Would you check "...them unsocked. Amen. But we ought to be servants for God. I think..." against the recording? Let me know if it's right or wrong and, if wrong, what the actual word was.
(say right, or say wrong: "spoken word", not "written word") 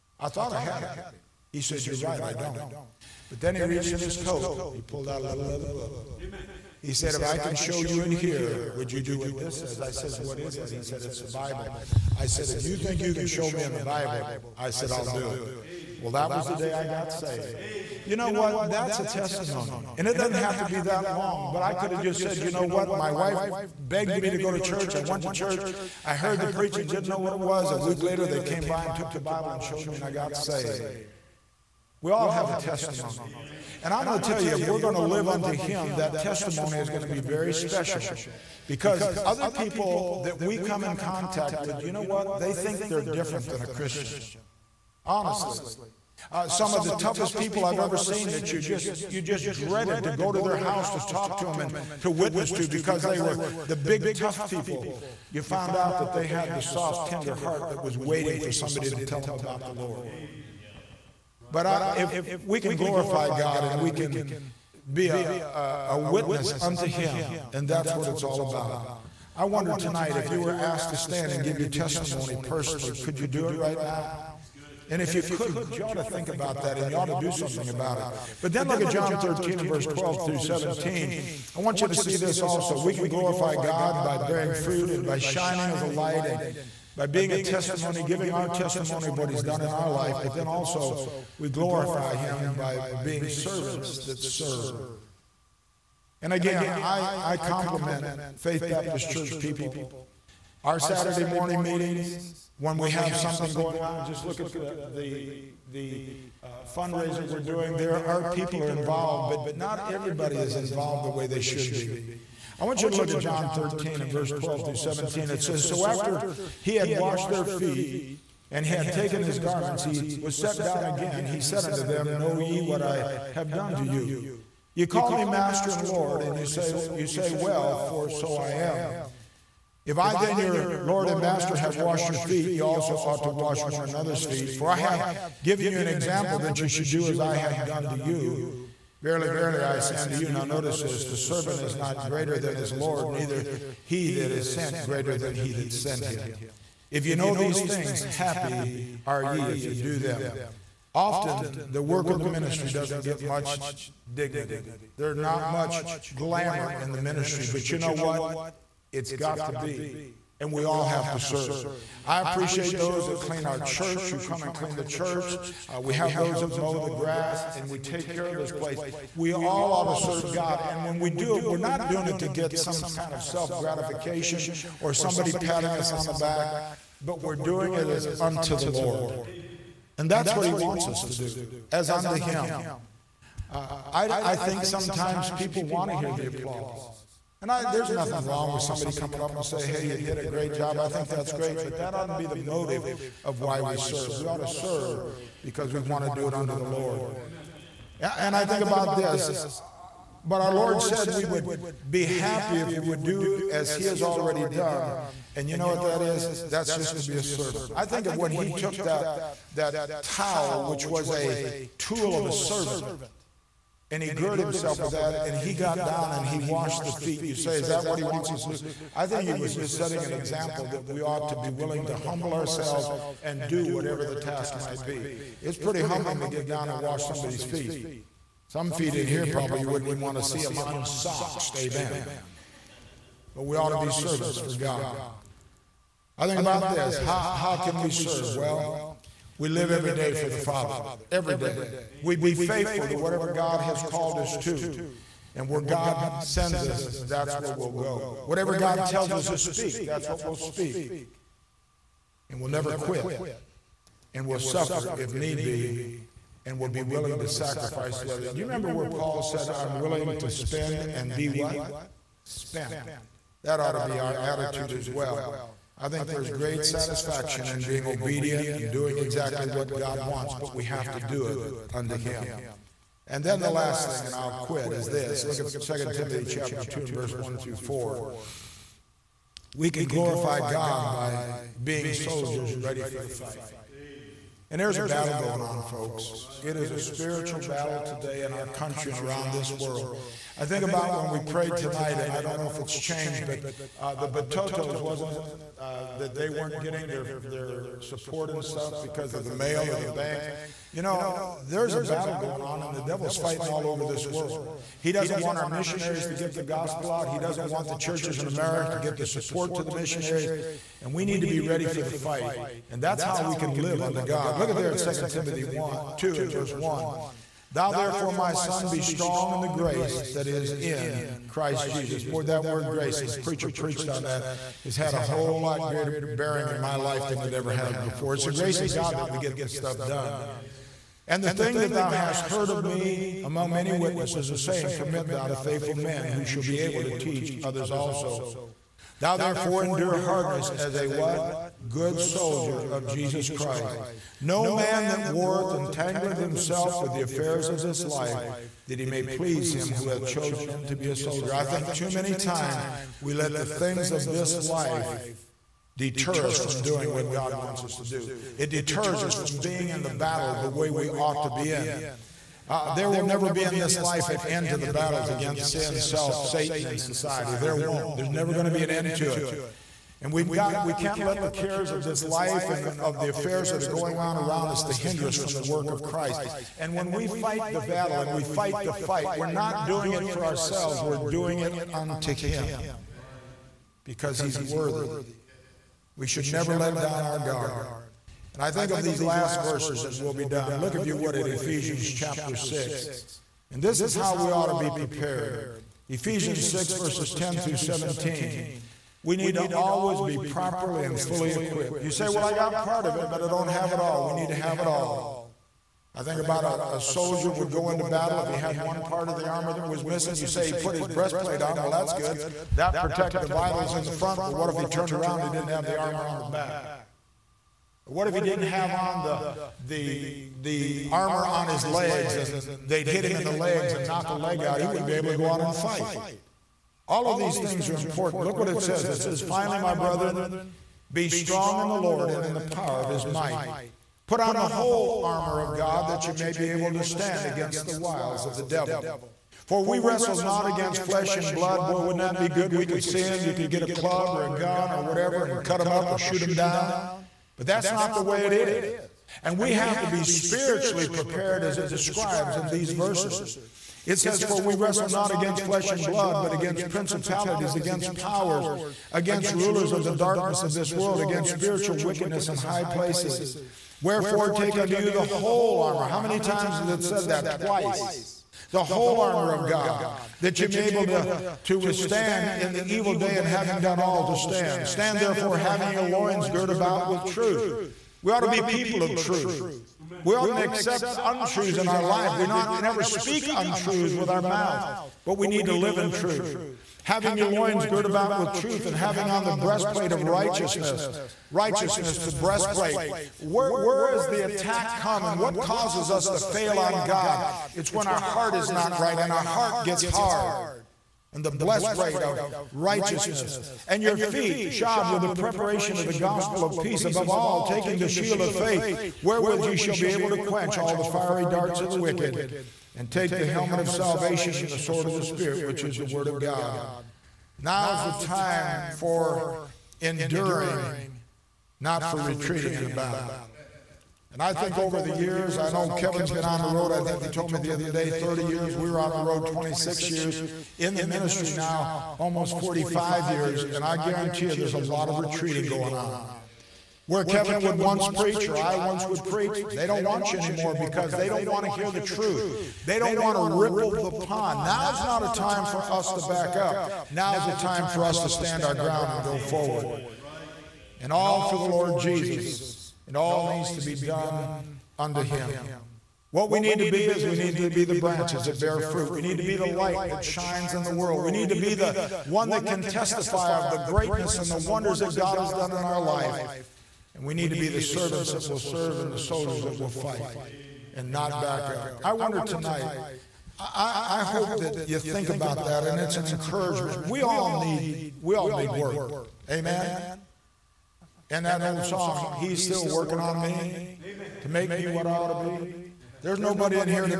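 right.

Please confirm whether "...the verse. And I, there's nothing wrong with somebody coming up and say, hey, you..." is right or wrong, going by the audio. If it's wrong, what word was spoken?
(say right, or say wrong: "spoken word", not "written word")
wrong: "applause", not "verse".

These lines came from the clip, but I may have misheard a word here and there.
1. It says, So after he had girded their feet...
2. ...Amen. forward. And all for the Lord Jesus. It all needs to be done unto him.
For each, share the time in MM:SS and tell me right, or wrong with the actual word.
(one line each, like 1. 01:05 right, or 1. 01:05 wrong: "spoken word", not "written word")
1. 01:55 wrong: "washed", not "girded"
2. 09:09 right.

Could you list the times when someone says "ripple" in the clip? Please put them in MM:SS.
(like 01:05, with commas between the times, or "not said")
09:03.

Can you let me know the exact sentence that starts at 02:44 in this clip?
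You come and clean the church.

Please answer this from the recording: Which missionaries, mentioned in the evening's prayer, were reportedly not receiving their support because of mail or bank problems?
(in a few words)
the Batotos.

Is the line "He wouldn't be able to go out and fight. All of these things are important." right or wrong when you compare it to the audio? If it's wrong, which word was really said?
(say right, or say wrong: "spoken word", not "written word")
right.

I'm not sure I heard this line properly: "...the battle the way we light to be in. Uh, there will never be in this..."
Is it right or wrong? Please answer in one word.
wrong.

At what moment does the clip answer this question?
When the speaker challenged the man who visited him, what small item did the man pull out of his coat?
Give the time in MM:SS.
00:05.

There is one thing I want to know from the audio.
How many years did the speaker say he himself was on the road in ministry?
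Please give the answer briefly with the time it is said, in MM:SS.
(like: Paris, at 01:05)
26, at 08:49.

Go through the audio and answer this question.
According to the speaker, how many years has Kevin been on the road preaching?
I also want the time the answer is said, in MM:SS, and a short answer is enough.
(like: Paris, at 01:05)
30, at 08:47.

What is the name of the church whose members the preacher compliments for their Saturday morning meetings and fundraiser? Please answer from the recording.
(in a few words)
Faith Baptist Church.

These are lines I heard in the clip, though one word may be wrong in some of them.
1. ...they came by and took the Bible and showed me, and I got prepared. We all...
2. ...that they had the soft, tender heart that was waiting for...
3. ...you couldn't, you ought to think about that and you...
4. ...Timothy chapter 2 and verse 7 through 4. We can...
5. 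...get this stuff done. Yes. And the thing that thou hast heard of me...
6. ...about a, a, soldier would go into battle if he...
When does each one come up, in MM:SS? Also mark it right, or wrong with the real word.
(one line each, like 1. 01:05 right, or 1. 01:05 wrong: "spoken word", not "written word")
1. 00:28 wrong: "saved", not "prepared"
2. 00:55 right
3. 01:15 right
4. 04:35 wrong: "1", not "7"
5. 05:29 right
6. 06:46 right.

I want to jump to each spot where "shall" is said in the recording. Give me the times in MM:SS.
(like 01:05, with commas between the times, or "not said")
05:36, 08:29.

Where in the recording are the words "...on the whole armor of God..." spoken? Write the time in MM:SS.
07:14.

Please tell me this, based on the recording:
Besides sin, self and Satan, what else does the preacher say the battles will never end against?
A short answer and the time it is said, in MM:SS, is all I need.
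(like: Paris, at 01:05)
society, at 06:06.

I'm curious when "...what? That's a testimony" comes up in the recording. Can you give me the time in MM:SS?
00:18.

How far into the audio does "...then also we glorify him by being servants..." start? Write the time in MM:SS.
01:30.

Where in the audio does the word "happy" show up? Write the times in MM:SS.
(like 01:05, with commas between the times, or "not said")
02:28, 03:22.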